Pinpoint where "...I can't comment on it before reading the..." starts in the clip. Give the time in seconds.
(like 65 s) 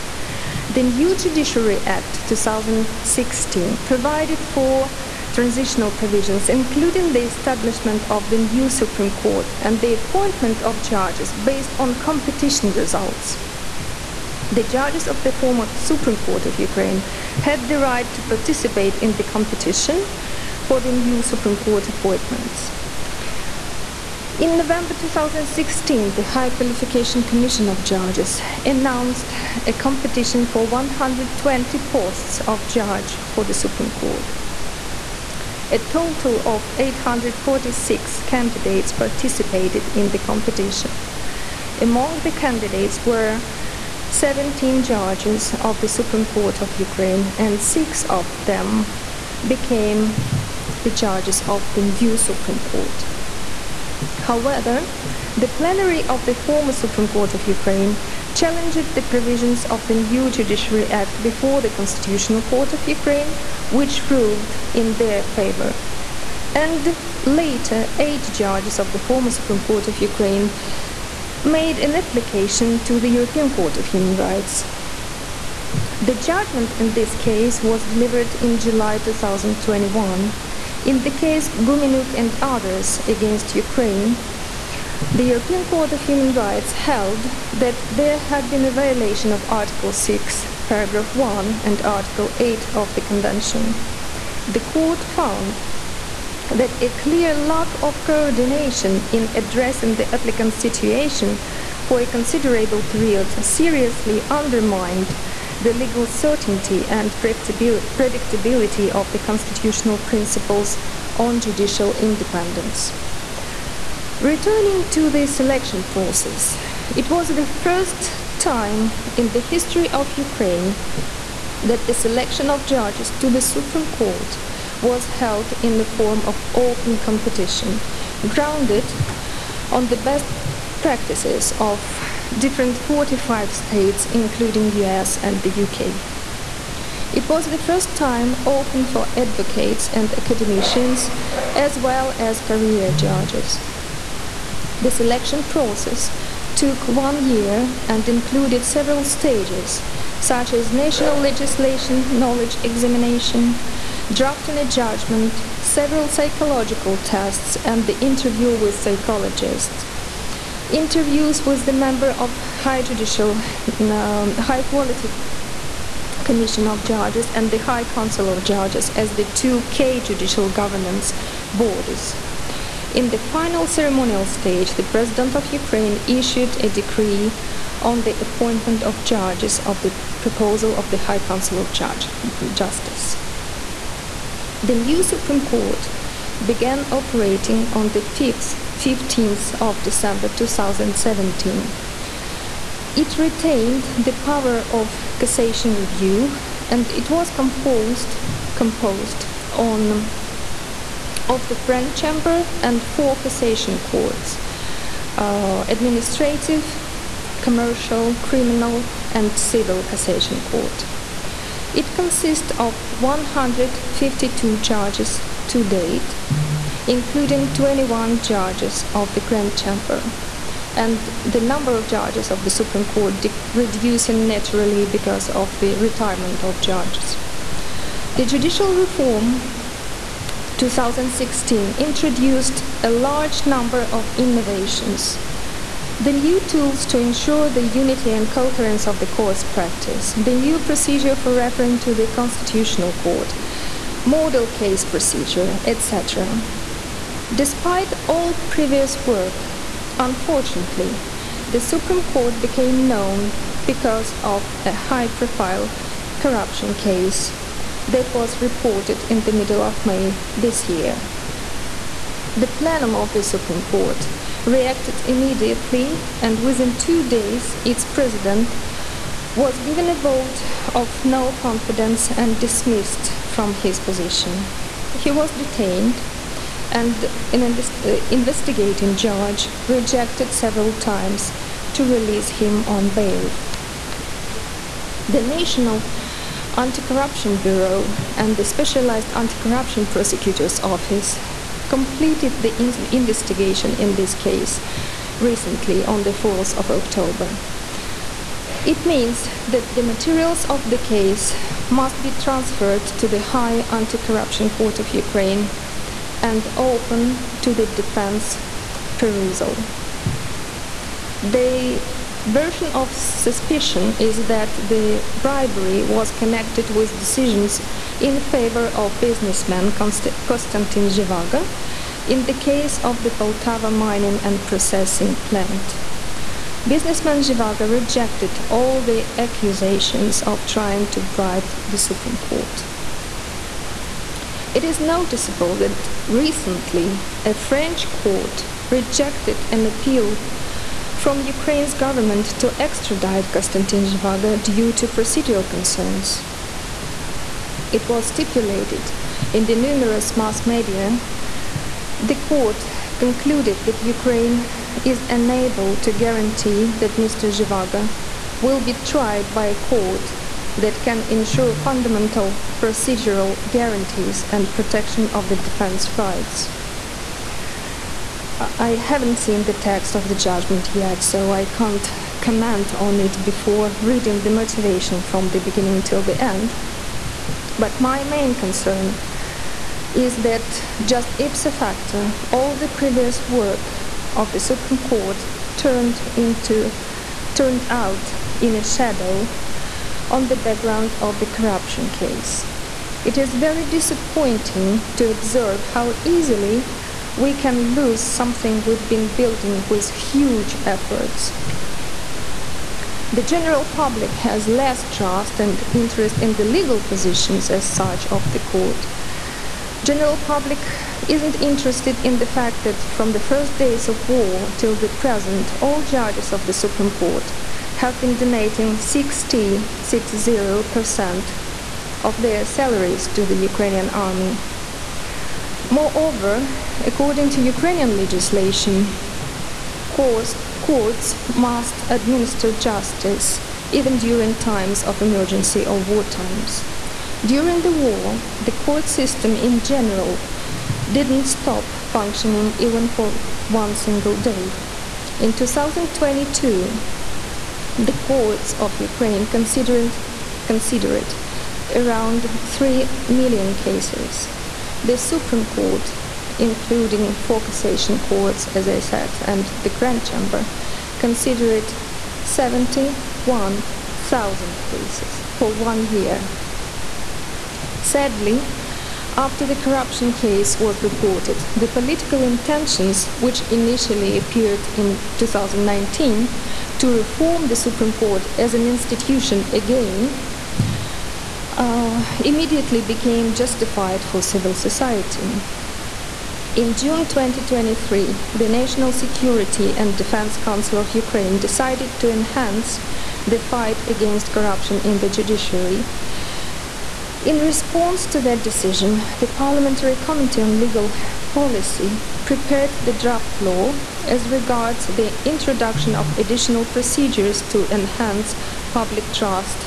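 371 s.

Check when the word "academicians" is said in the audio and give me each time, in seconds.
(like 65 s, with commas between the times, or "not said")
140 s.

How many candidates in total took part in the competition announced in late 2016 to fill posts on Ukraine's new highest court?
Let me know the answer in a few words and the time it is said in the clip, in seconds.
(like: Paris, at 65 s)
846, at 36 s.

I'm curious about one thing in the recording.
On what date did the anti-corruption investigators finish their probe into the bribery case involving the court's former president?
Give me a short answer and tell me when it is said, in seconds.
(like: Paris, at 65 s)
4 October, at 296 s.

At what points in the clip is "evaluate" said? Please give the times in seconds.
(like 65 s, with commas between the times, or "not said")
not said.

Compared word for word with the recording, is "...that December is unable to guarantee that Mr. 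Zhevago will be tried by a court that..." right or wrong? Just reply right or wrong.
wrong.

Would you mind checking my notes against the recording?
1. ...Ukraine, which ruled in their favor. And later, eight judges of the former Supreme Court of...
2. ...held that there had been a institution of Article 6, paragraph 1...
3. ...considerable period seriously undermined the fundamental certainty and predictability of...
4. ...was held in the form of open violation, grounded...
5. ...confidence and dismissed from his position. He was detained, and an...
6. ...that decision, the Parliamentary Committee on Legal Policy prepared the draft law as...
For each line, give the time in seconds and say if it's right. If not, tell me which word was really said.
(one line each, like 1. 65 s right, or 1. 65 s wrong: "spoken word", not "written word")
1. 62 s right
2. 86 s wrong: "violation", not "institution"
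3. 102 s wrong: "legal", not "fundamental"
4. 124 s wrong: "competition", not "violation"
5. 271 s right
6. 498 s right.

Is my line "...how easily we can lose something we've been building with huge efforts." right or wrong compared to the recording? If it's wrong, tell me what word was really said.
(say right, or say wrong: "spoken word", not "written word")
right.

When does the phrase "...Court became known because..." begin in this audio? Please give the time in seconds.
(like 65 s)
252 s.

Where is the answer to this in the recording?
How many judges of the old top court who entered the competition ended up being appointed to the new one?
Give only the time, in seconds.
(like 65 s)
47 s.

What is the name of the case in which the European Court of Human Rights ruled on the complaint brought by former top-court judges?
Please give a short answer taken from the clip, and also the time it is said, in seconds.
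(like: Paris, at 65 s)
Gumenyuk and others against Ukraine, at 81 s.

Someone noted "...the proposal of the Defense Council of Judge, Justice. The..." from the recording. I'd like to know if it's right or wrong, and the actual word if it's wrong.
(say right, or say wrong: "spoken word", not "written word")
wrong: "High", not "Defense".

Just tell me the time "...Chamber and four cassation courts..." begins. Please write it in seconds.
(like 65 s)
201 s.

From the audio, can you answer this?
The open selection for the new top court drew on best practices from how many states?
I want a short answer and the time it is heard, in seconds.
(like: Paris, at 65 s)
45, at 132 s.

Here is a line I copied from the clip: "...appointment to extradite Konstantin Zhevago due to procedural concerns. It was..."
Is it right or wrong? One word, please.
wrong.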